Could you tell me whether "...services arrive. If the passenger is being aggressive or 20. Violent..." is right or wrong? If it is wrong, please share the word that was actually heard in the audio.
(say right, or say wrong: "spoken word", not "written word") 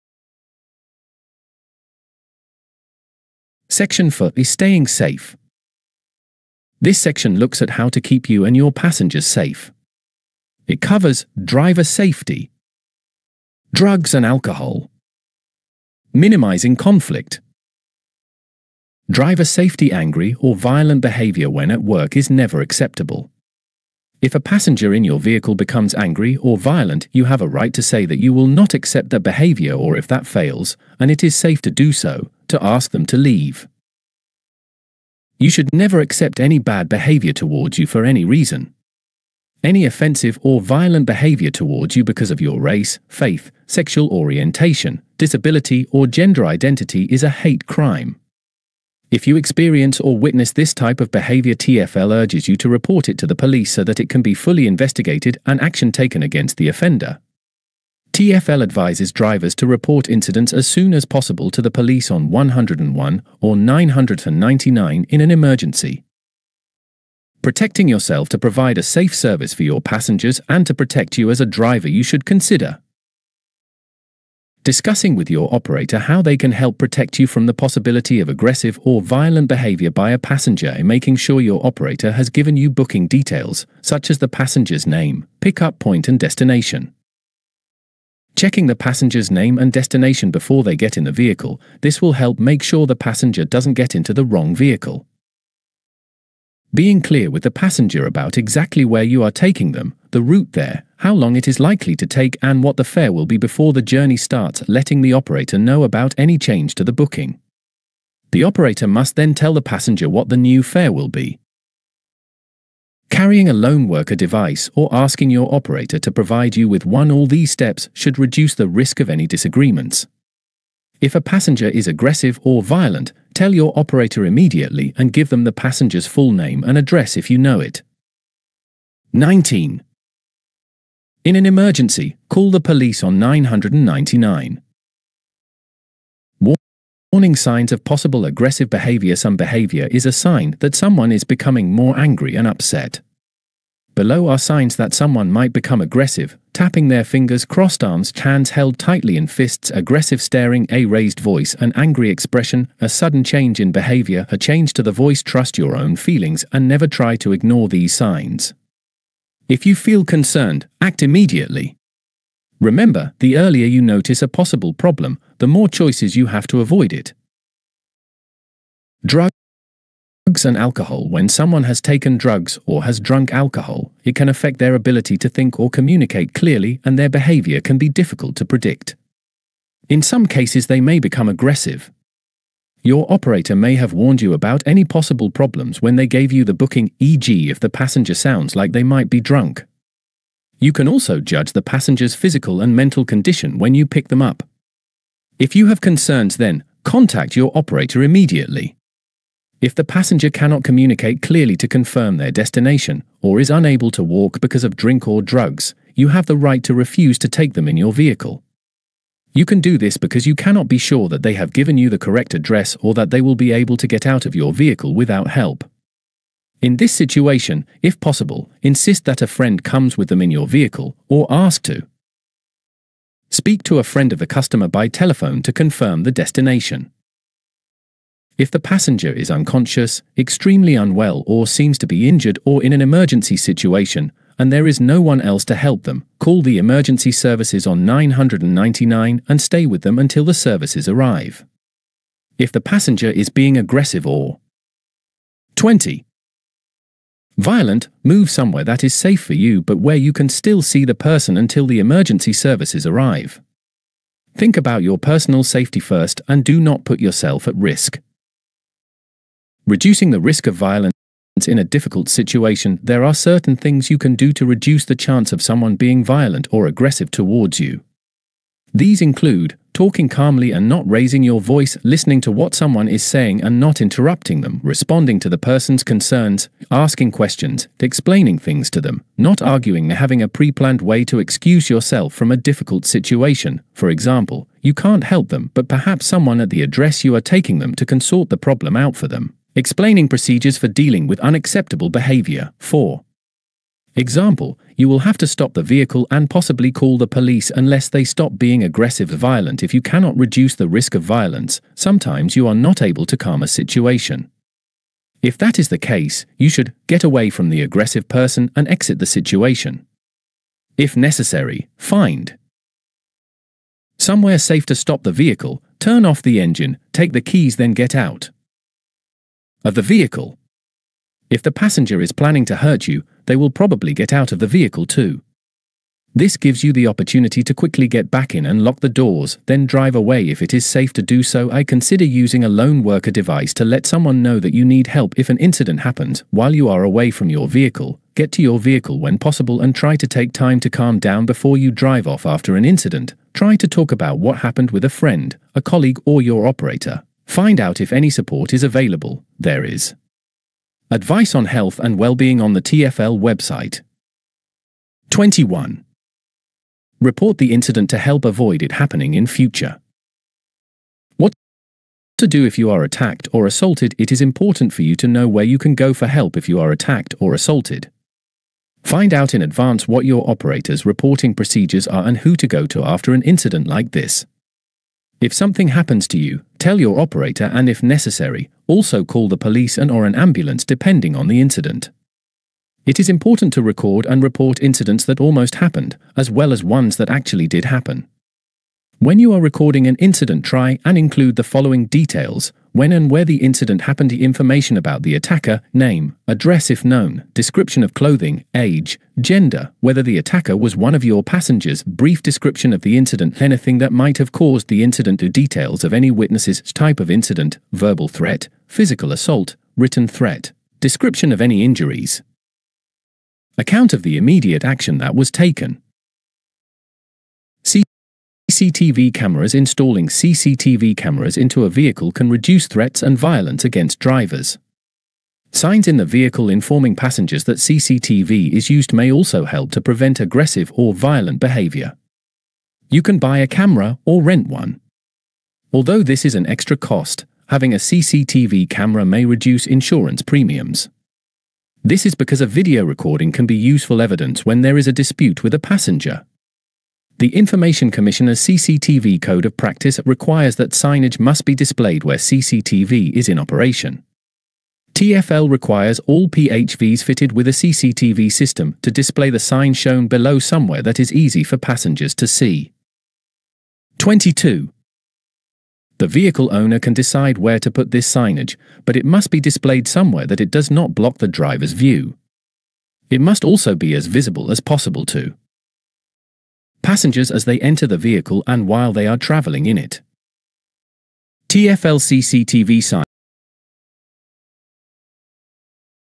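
right.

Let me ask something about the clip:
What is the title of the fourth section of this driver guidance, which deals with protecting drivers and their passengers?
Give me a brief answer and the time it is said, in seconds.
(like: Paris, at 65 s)
Staying Safe, at 4 s.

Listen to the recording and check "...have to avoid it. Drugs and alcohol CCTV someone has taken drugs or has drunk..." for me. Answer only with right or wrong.
wrong.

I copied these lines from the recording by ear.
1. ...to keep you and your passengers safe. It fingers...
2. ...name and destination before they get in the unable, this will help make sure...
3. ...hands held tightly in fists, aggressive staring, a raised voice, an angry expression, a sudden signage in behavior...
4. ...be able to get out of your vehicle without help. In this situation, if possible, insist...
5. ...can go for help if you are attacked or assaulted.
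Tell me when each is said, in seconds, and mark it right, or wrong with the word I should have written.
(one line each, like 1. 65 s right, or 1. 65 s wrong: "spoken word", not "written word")
1. 7 s wrong: "covers", not "fingers"
2. 89 s wrong: "vehicle", not "unable"
3. 148 s wrong: "change", not "signage"
4. 213 s right
5. 365 s right.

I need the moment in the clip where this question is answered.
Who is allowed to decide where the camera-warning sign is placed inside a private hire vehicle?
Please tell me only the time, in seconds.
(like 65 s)
465 s.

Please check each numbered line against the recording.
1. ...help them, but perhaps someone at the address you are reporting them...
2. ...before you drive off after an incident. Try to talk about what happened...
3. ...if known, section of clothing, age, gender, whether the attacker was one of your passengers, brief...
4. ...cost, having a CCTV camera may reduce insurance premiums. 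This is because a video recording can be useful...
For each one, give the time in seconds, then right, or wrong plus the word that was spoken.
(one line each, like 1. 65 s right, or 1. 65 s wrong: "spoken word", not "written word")
1. 285 s wrong: "taking", not "reporting"
2. 341 s right
3. 396 s wrong: "description", not "section"
4. 436 s right.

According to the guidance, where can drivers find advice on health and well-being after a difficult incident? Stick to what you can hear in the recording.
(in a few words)
TFL website.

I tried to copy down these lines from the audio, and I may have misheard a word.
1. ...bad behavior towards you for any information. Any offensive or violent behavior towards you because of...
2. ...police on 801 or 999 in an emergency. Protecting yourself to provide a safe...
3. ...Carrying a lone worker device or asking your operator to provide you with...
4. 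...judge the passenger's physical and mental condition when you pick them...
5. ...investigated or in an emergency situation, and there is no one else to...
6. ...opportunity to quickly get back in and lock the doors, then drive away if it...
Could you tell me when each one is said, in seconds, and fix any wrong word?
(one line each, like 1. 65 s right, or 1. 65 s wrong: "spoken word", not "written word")
1. 36 s wrong: "reason", not "information"
2. 61 s wrong: "101", not "801"
3. 113 s right
4. 191 s right
5. 232 s wrong: "injured", not "investigated"
6. 326 s right.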